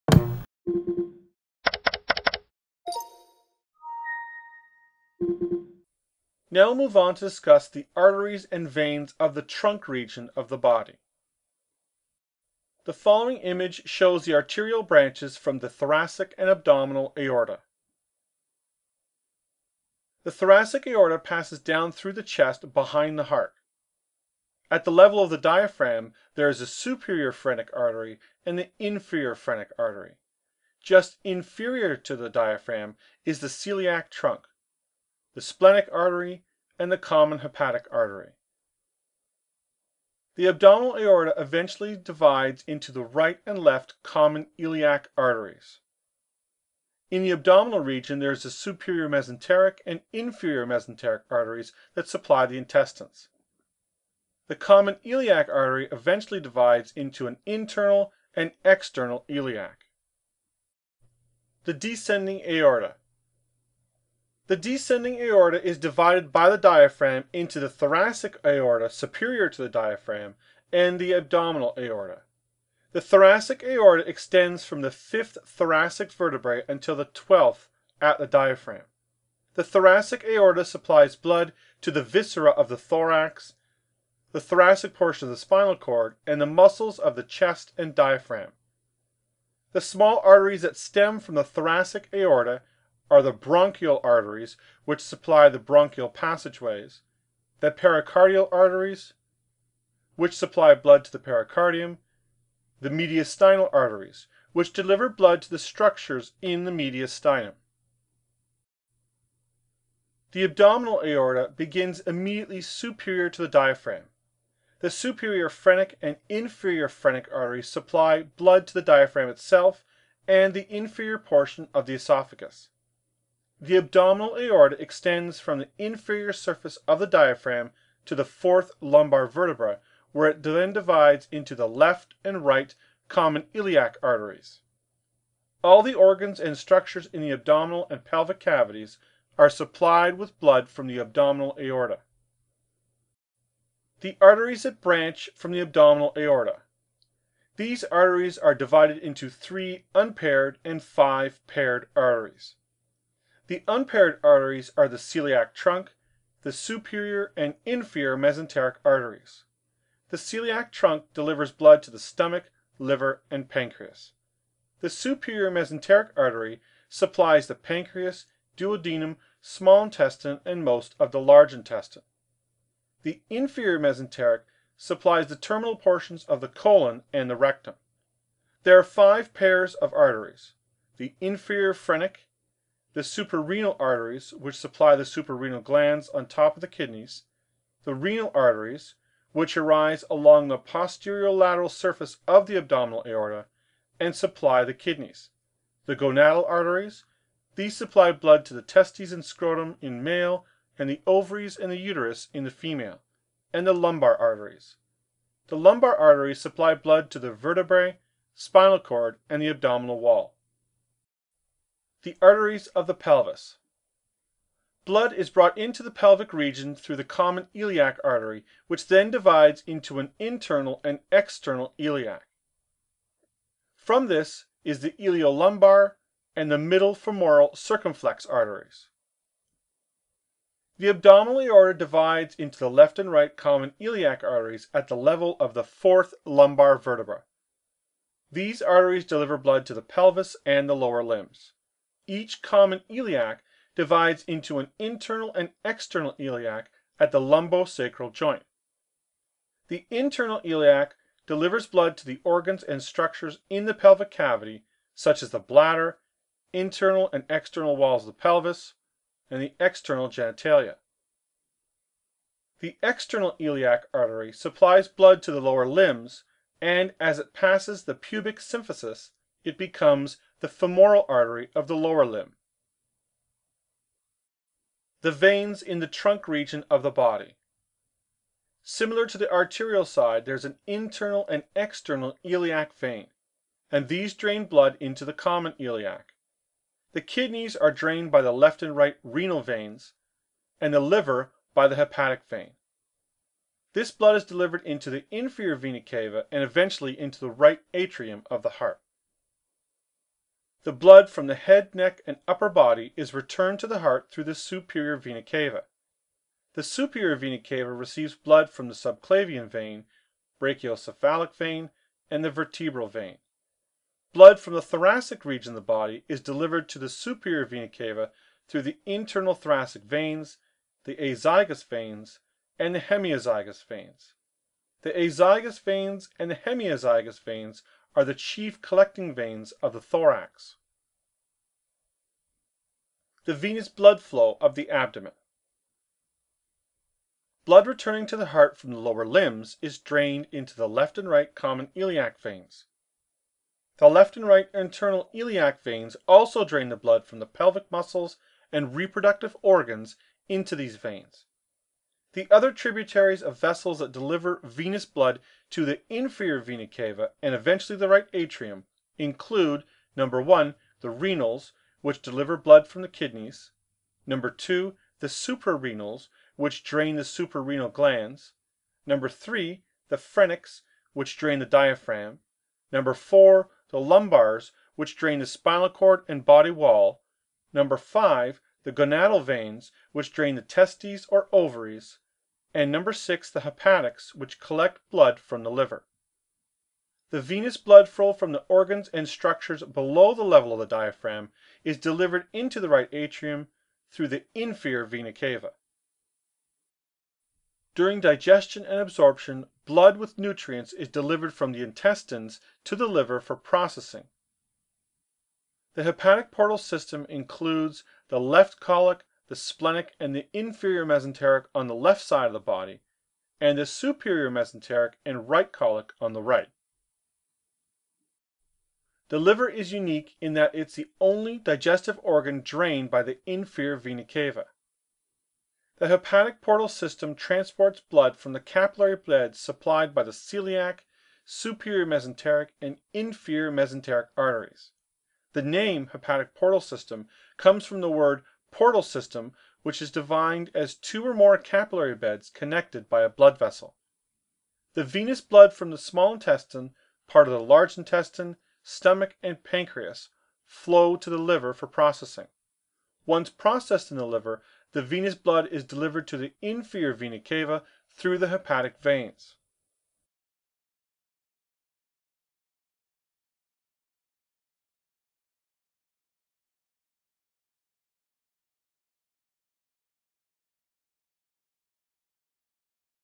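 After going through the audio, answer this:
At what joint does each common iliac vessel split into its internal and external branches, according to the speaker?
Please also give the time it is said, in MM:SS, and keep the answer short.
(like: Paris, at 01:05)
Lumbosacral joint, at 04:07.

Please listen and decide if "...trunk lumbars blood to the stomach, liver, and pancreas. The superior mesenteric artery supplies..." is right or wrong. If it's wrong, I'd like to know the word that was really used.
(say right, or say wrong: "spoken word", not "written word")
wrong: "delivers", not "lumbars".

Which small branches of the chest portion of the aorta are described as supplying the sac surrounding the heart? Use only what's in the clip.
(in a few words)
Pericardial arteries.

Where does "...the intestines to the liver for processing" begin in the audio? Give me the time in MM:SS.
06:41.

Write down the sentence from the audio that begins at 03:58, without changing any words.
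These arteries deliver blood to the pelvis and the lower limbs.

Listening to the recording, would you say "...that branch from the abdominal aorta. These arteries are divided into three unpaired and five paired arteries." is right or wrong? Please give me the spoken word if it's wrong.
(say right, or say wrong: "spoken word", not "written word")
right.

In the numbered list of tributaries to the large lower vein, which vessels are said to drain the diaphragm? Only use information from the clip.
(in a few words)
Phrenics.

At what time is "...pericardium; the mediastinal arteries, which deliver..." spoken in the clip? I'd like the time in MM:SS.
01:41.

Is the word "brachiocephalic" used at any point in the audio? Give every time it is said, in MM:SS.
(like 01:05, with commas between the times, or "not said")
05:10.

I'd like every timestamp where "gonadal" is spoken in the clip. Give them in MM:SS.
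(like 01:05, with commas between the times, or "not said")
03:15, 06:18.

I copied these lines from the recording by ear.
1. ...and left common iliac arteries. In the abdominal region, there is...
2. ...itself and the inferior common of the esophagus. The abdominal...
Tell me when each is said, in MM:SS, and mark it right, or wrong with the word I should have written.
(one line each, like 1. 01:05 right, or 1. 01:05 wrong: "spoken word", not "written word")
1. 00:43 right
2. 01:59 wrong: "portion", not "common".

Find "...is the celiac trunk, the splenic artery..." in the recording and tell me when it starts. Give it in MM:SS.
00:33.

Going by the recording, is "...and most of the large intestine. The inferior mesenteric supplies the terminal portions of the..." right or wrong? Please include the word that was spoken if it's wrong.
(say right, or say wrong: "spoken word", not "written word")
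right.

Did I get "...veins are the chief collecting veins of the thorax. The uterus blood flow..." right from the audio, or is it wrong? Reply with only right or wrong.
wrong.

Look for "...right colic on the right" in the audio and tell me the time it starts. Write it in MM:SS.
06:55.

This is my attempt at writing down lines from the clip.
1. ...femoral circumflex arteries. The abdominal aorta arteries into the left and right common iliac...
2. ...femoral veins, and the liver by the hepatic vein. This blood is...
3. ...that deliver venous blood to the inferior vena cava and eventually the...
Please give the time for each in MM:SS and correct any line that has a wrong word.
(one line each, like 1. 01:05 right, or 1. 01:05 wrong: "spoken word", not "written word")
1. 03:46 wrong: "divides", not "arteries"
2. 04:49 wrong: "renal", not "femoral"
3. 05:53 right.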